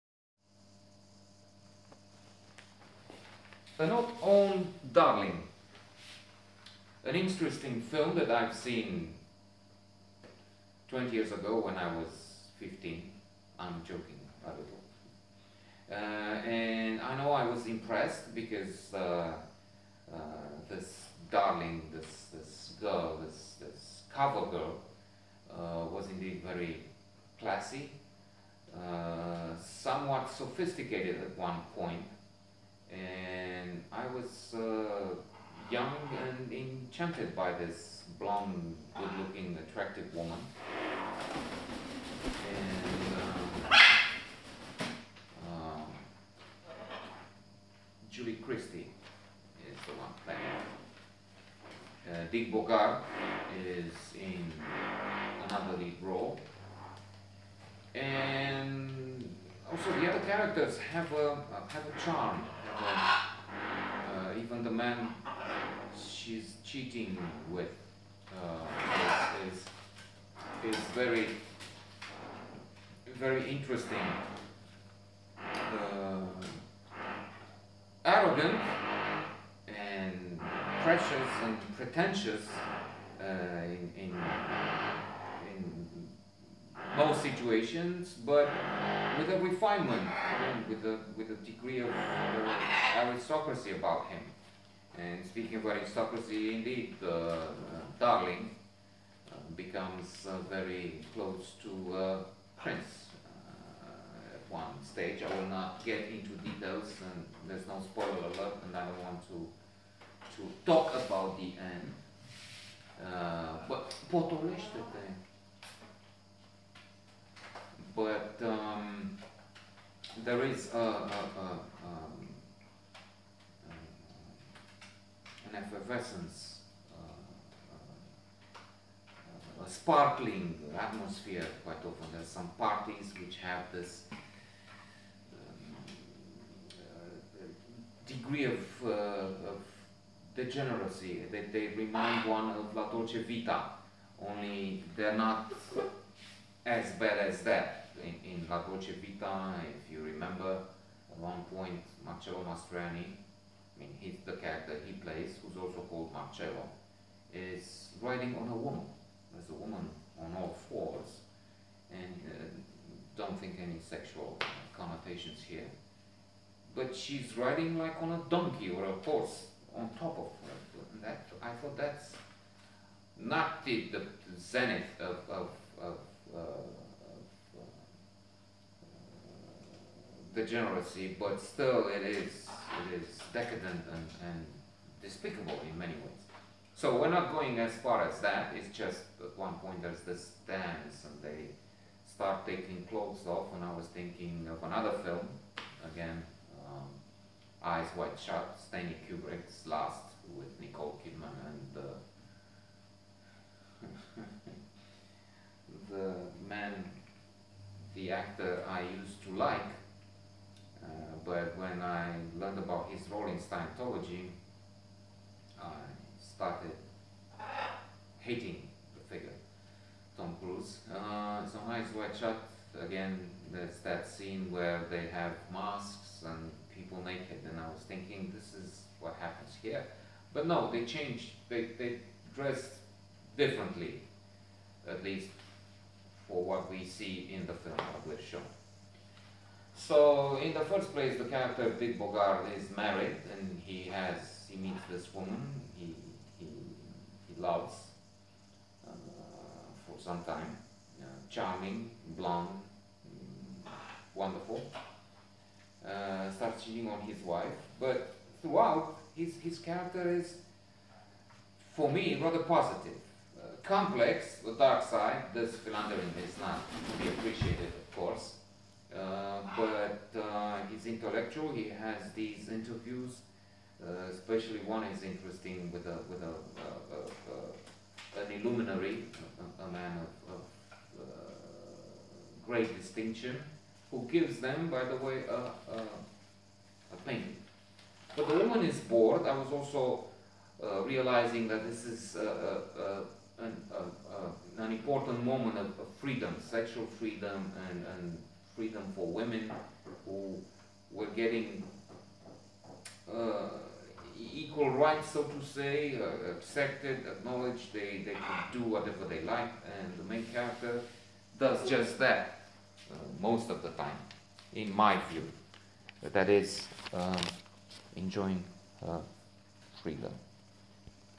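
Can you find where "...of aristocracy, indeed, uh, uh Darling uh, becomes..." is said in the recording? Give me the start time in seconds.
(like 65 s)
95 s.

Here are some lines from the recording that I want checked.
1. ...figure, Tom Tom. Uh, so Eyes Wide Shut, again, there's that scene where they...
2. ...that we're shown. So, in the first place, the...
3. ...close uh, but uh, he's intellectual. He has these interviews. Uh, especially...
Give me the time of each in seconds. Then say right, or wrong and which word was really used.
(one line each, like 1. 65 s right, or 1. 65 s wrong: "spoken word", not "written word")
1. 219 s wrong: "Cruise", not "Tom"
2. 237 s right
3. 267 s wrong: "course", not "close".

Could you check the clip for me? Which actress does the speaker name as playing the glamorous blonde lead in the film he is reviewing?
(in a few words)
Julie Christie.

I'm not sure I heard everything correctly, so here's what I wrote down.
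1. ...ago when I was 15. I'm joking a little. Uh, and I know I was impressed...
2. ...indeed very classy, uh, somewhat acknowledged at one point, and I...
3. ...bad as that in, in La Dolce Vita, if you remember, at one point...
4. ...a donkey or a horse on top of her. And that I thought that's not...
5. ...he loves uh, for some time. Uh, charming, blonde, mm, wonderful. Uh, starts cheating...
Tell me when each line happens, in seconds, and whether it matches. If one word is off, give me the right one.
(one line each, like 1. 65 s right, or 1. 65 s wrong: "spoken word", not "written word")
1. 11 s right
2. 26 s wrong: "sophisticated", not "acknowledged"
3. 146 s right
4. 168 s right
5. 247 s right.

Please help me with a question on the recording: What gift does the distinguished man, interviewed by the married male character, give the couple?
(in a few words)
a painting.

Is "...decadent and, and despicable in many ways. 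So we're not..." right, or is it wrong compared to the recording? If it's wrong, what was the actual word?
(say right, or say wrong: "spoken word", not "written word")
right.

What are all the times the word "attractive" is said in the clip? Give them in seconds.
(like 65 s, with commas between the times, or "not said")
39 s.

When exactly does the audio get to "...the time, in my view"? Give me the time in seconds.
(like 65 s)
313 s.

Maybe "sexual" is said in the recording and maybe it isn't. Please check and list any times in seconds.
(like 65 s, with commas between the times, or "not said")
163 s, 296 s.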